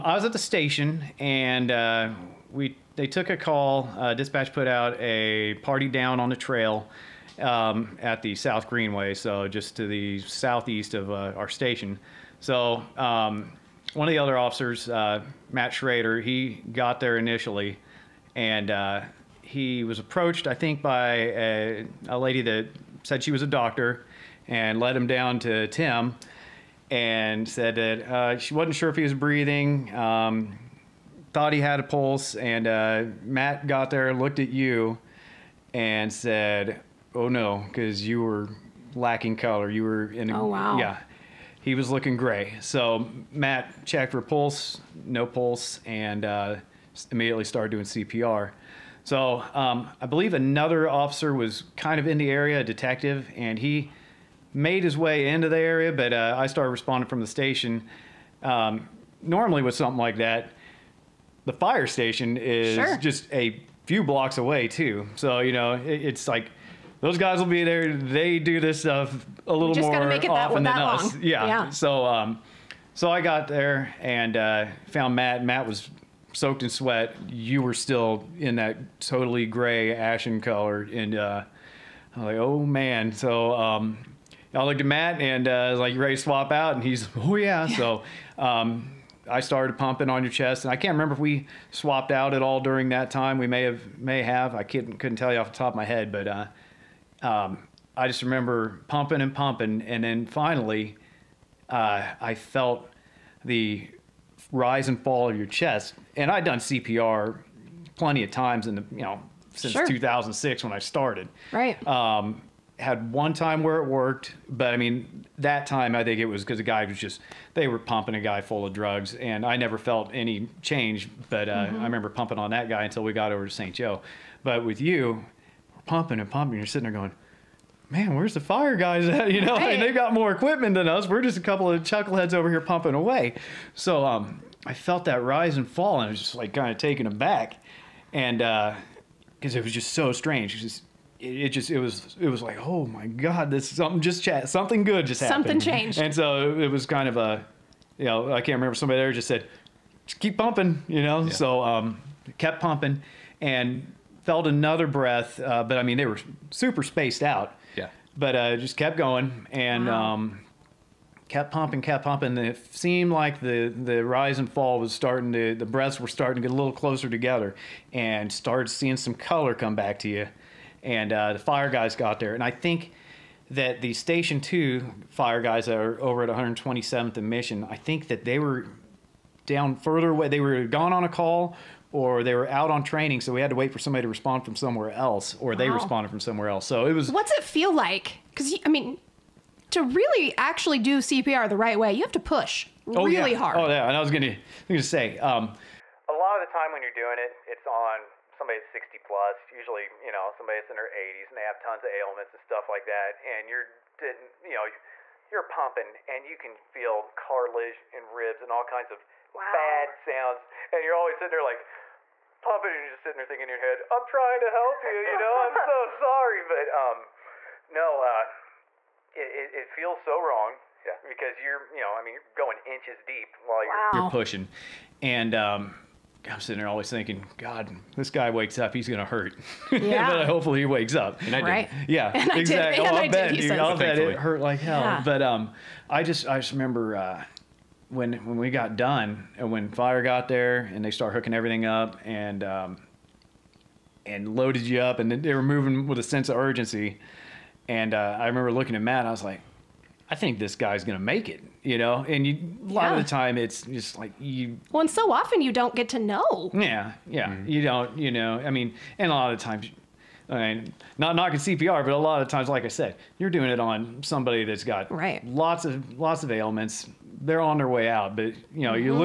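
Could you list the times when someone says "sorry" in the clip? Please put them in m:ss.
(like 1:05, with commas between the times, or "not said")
3:35.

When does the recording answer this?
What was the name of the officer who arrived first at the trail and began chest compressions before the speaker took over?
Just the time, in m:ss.
0:15.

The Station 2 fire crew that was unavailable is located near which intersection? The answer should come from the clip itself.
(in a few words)
127th and Mission.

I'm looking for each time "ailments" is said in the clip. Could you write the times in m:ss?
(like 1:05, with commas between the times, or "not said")
3:21, 4:26.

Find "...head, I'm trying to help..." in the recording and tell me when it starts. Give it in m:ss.
3:33.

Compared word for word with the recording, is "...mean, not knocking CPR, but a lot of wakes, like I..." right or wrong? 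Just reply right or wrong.
wrong.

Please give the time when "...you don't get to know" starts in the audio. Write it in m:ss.
4:15.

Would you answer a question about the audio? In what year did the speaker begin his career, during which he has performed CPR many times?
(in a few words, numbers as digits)
2006.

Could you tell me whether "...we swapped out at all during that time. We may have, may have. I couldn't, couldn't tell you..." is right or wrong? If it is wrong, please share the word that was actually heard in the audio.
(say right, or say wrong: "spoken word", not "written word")
right.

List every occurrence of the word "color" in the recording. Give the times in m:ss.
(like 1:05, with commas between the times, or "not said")
0:39, 1:20, 2:49.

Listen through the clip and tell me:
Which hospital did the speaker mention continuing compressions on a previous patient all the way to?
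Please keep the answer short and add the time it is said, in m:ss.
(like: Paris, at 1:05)
St. Joe, at 2:03.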